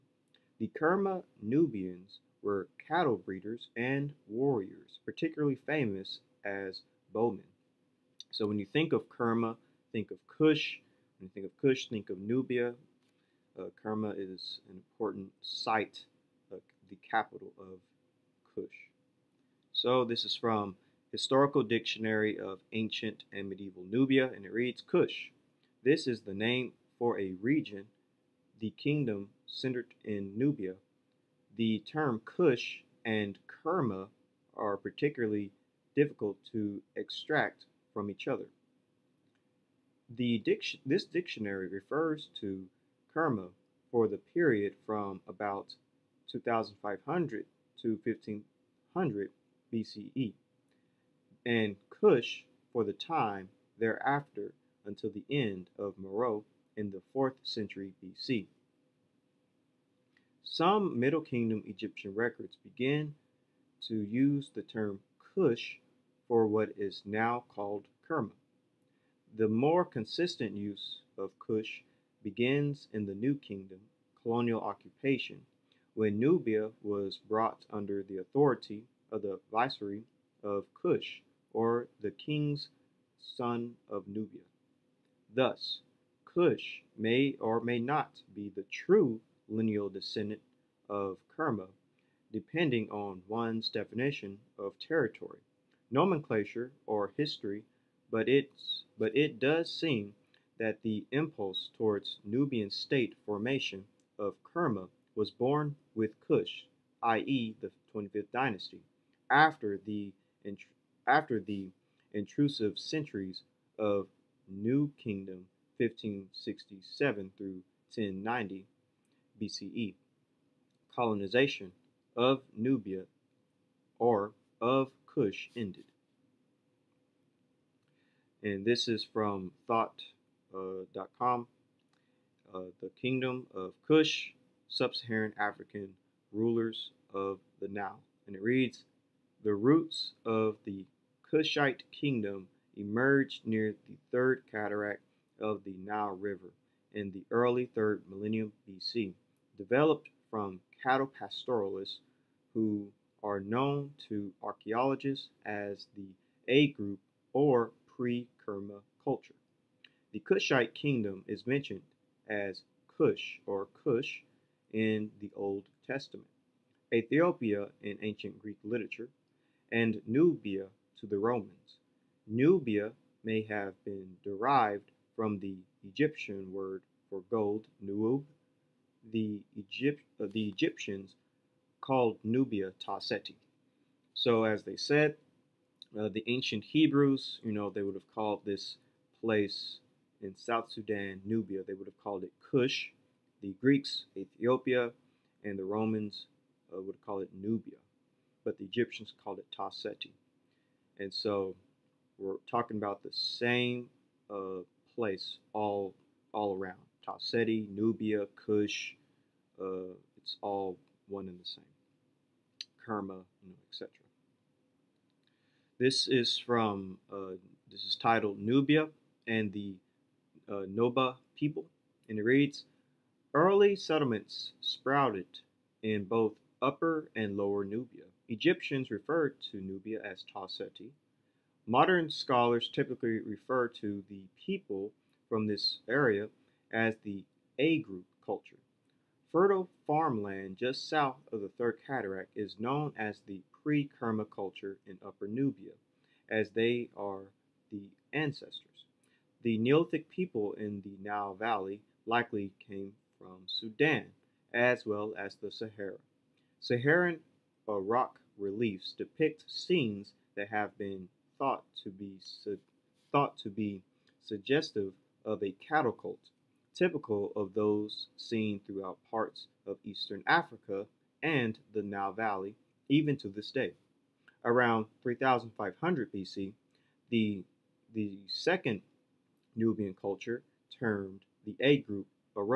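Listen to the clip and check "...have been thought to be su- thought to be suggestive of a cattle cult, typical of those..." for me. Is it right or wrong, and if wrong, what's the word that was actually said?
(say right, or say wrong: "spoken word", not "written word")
right.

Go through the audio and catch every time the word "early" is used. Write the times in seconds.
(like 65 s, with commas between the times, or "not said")
147 s, 223 s.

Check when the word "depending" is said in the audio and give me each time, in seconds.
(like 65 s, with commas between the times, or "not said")
92 s.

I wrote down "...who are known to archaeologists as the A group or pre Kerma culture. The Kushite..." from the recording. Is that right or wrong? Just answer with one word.
right.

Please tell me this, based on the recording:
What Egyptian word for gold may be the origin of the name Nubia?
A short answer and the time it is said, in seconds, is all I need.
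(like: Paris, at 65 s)
nuub, at 177 s.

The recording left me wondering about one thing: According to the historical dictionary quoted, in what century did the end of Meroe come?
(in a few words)
4th century BC.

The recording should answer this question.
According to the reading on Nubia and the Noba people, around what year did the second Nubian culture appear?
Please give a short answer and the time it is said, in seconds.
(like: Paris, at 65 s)
3500 BC, at 275 s.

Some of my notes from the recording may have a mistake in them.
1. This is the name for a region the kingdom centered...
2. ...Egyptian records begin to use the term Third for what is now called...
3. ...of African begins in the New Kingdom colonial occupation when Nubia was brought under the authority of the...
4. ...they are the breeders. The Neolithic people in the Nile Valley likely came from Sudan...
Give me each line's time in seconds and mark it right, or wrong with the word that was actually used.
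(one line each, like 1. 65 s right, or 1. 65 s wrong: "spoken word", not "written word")
1. 25 s right
2. 61 s wrong: "Kush", not "Third"
3. 71 s wrong: "Kush", not "African"
4. 246 s wrong: "ancestors", not "breeders".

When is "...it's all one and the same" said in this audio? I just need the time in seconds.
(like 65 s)
210 s.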